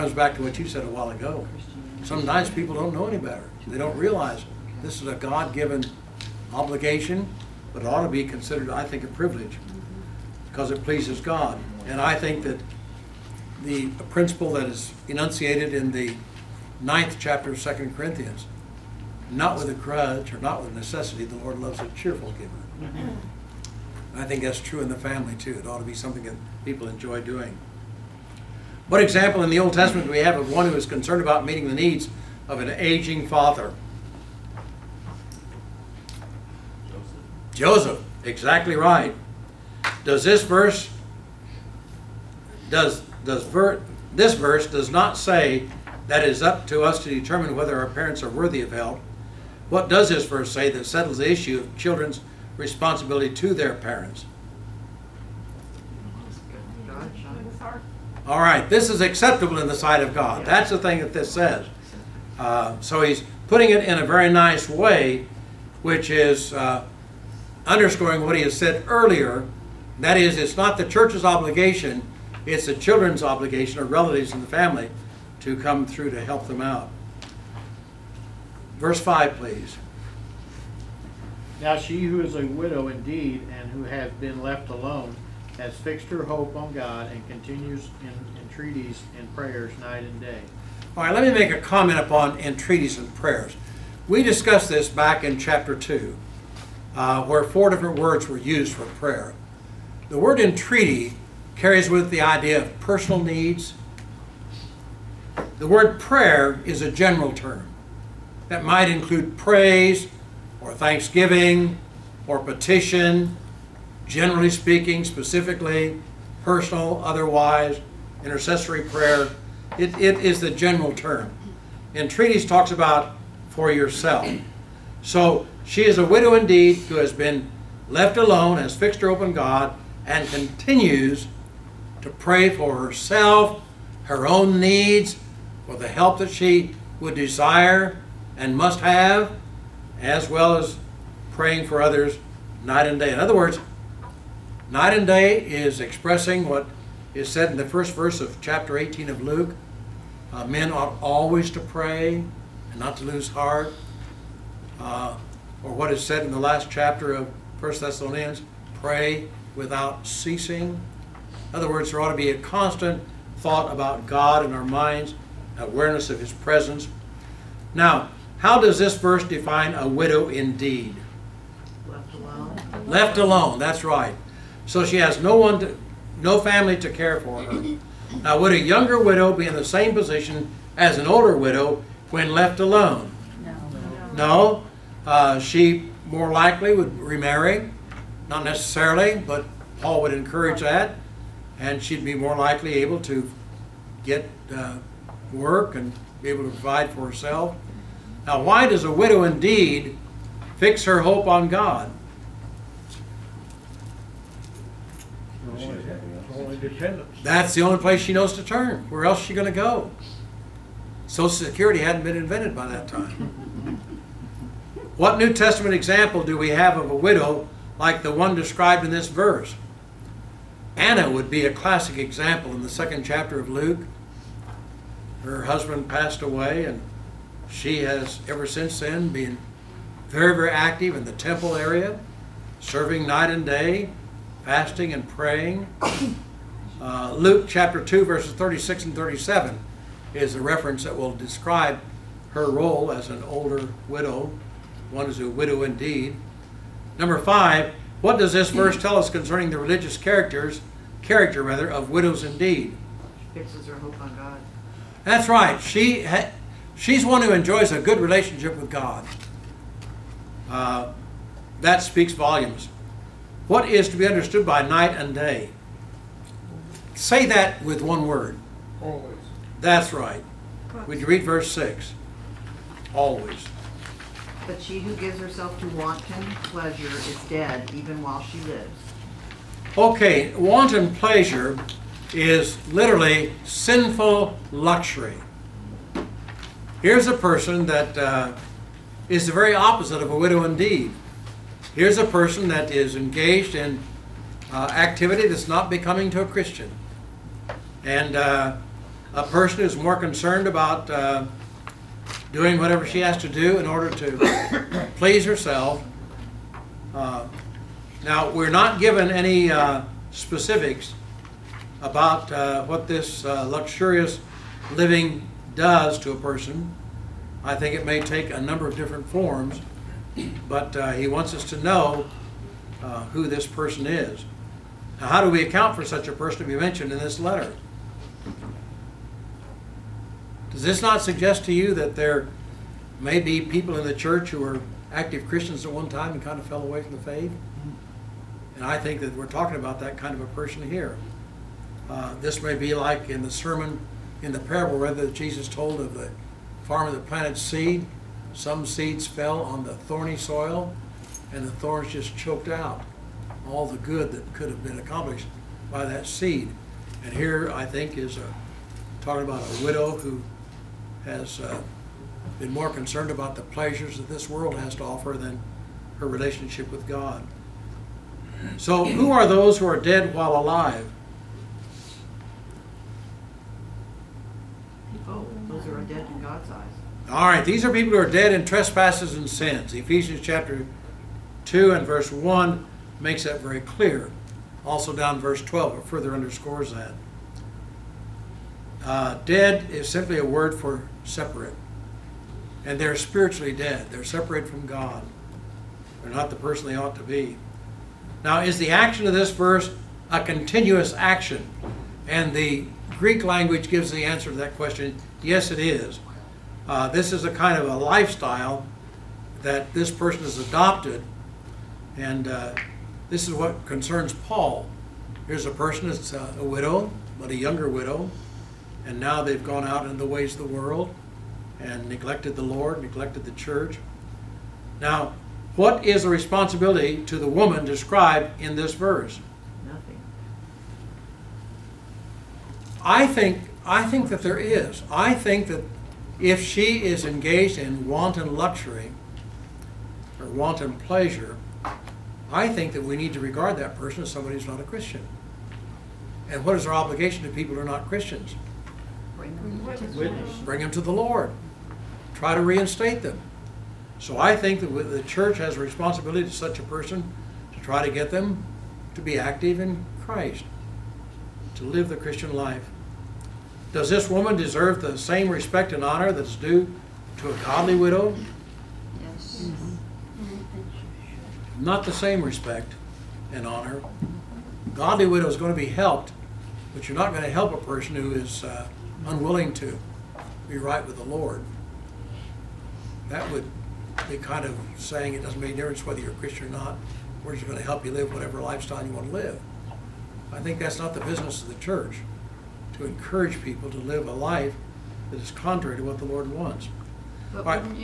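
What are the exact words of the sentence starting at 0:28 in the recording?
What example in the Old Testament do we have of one who is concerned about meeting the needs of an aging father?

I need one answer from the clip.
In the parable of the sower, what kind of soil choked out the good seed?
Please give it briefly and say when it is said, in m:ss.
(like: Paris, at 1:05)
thorny soil, at 5:49.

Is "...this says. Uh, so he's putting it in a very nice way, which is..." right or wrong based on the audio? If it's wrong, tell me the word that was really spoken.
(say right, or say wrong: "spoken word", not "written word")
right.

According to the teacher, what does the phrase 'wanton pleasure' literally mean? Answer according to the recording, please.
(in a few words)
sinful luxury.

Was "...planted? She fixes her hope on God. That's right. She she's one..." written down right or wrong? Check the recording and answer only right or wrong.
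wrong.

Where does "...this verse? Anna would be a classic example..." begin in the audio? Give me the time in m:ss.
3:38.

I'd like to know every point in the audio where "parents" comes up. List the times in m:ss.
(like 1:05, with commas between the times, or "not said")
0:47, 0:53.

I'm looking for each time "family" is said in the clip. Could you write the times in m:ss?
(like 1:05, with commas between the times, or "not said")
0:24, 1:14, 2:56.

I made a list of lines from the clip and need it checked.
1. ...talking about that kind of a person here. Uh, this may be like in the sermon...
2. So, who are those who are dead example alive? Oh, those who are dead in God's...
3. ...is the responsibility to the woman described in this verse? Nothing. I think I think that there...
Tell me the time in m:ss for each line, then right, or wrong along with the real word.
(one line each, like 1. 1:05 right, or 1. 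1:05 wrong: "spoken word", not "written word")
1. 5:39 right
2. 6:08 wrong: "while", not "example"
3. 7:05 right.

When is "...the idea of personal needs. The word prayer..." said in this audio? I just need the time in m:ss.
1:42.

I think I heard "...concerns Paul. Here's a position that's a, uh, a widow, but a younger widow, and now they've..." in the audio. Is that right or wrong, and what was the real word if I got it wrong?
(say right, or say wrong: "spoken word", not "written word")
wrong: "person", not "position".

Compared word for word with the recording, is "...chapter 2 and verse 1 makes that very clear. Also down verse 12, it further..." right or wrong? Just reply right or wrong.
right.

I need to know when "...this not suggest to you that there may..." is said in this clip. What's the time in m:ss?
5:30.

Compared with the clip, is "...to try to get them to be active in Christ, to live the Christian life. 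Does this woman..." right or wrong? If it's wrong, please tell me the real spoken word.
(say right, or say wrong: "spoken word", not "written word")
right.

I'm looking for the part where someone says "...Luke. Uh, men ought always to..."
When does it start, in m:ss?
2:29.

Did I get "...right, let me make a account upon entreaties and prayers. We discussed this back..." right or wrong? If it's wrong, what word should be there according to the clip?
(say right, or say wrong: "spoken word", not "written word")
wrong: "comment", not "account".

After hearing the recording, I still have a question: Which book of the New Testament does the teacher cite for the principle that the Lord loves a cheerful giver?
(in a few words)
Second Corinthians.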